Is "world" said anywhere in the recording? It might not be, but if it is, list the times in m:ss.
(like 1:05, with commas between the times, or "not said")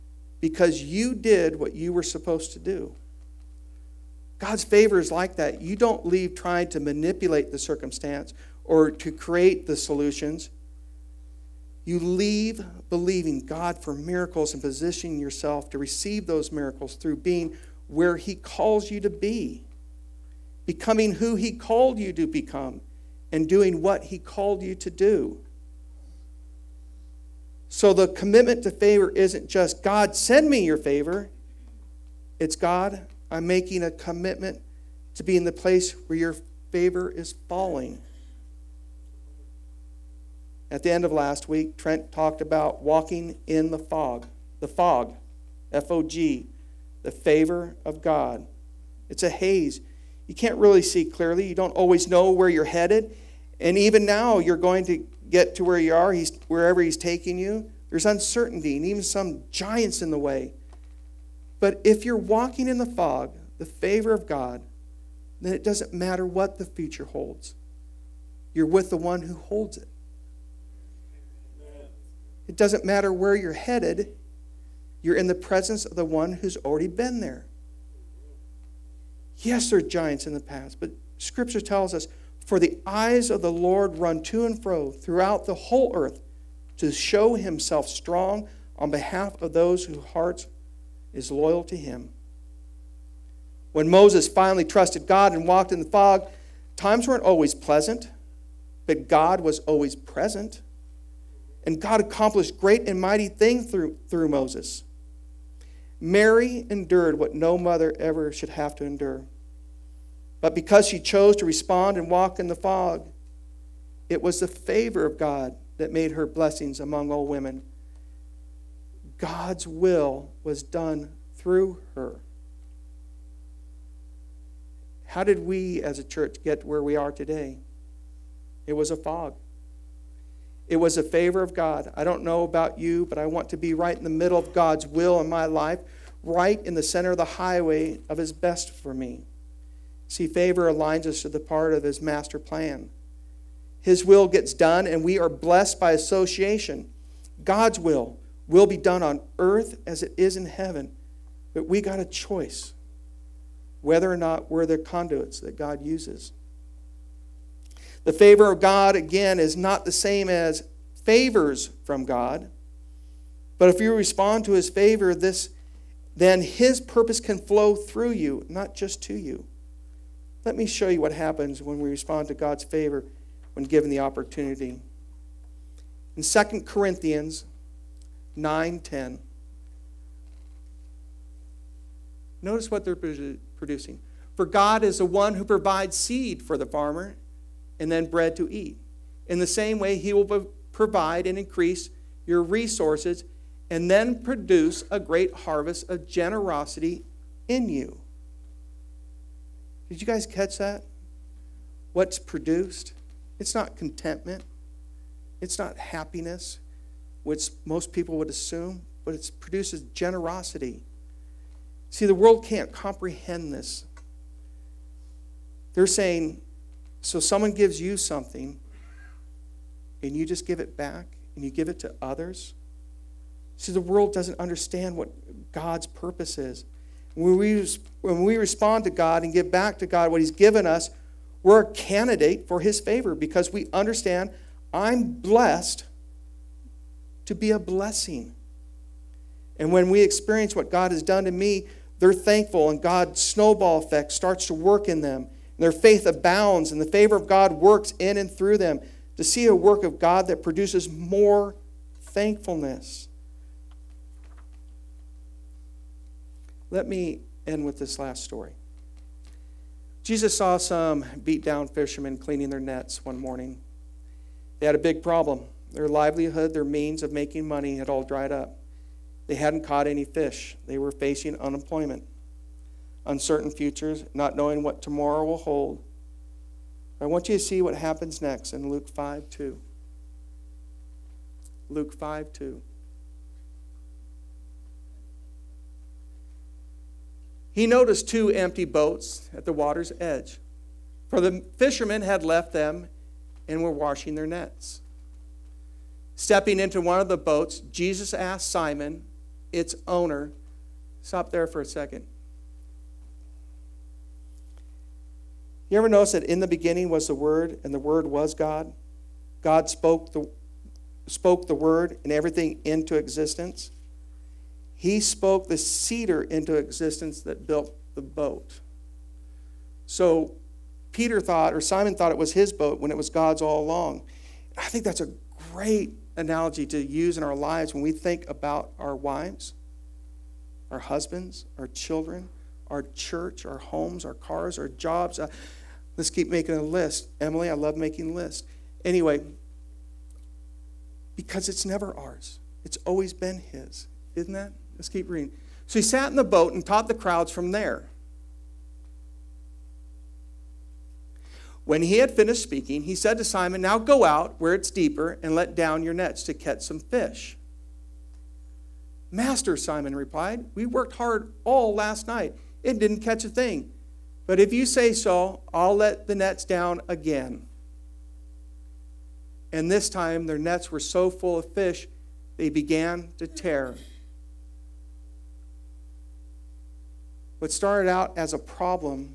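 3:32, 3:43.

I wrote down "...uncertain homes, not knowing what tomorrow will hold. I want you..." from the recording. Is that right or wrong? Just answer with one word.
wrong.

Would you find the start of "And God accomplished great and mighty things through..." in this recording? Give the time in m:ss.
1:41.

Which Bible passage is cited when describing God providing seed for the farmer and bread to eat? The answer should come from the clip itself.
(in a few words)
2 Corinthians 9:10.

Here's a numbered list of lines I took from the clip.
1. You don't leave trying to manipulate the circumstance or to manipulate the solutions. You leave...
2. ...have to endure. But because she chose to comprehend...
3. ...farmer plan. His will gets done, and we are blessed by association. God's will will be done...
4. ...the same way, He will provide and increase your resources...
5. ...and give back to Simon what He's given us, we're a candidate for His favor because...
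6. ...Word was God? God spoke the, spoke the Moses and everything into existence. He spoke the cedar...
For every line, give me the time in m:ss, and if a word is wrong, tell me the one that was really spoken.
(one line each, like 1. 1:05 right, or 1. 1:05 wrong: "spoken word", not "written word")
1. 0:05 wrong: "create", not "manipulate"
2. 1:48 wrong: "respond", not "comprehend"
3. 2:22 wrong: "master", not "farmer"
4. 3:09 right
5. 3:49 wrong: "God", not "Simon"
6. 5:07 wrong: "Word", not "Moses".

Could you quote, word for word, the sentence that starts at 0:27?
So the commitment to favor isn't just God, send me your favor.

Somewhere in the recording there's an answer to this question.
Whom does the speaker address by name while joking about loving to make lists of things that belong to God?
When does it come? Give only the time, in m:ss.
5:37.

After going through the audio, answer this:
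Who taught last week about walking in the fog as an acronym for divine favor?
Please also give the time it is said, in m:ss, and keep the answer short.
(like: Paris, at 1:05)
Trent, at 0:41.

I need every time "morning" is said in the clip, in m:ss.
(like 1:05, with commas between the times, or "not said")
4:23.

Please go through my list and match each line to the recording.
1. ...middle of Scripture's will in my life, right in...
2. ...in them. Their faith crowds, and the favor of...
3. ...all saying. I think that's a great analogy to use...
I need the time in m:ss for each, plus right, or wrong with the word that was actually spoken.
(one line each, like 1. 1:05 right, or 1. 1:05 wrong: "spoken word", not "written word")
1. 2:14 wrong: "God", not "Scripture"
2. 4:04 wrong: "abounds", not "crowds"
3. 5:23 wrong: "along", not "saying".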